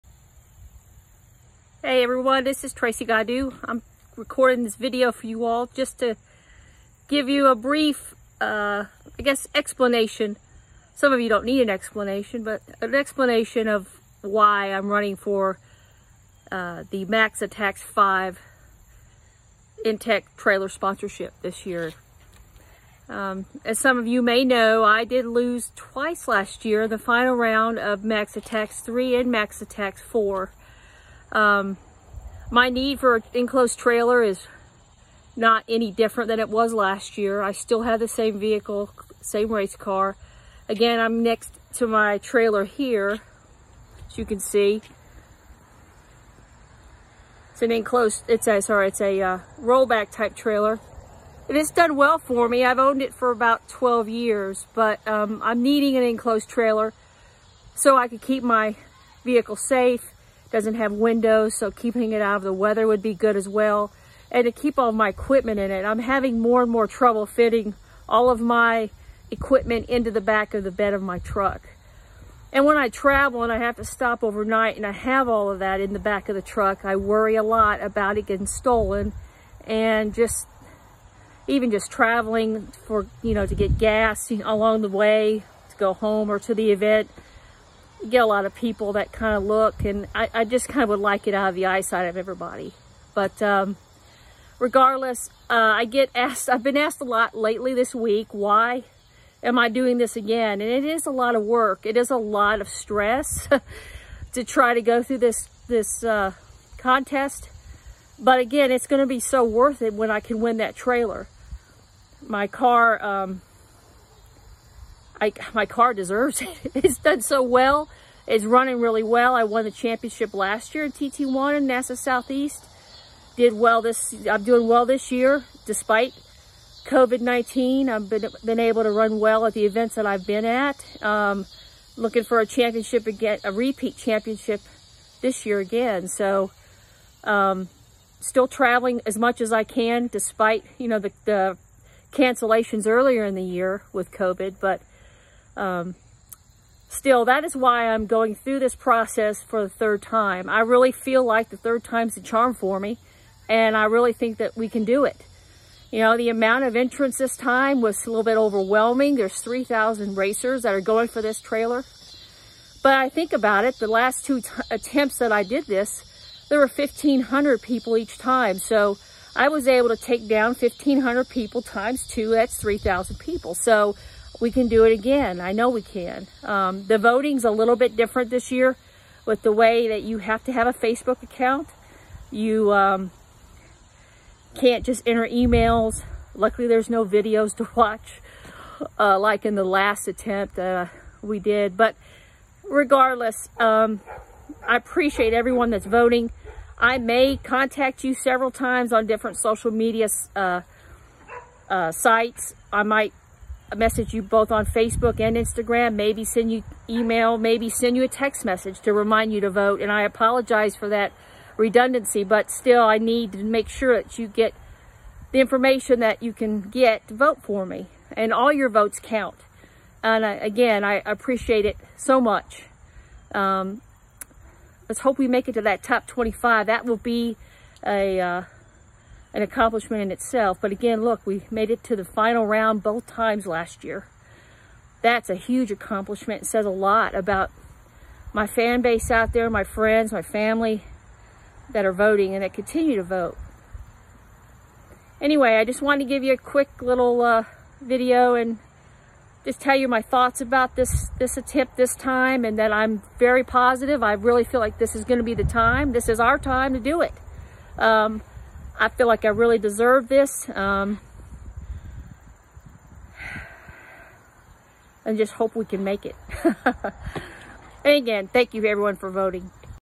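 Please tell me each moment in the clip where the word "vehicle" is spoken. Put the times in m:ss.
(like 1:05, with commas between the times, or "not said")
0:38, 0:59.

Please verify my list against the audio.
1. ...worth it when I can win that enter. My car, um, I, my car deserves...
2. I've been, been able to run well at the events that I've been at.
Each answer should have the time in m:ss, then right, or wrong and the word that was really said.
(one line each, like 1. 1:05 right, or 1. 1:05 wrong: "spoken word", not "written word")
1. 1:49 wrong: "trailer", not "enter"
2. 2:07 right.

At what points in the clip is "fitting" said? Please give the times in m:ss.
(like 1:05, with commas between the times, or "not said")
1:07.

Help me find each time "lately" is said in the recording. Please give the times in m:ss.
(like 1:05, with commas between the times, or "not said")
1:37.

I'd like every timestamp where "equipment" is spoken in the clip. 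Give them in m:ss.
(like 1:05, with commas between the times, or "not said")
1:05, 1:09.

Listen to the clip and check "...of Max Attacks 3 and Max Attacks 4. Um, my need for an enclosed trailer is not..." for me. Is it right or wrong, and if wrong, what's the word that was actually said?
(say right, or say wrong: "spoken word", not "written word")
right.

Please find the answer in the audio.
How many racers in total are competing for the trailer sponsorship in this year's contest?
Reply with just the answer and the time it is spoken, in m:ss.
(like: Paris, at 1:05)
3,000, at 2:39.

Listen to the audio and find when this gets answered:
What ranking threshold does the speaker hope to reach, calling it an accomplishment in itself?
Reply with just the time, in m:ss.
3:45.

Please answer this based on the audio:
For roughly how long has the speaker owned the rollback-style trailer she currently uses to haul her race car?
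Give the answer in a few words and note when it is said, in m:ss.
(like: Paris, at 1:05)
12 years, at 0:53.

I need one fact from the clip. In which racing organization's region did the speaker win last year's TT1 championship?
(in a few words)
NASA Southeast.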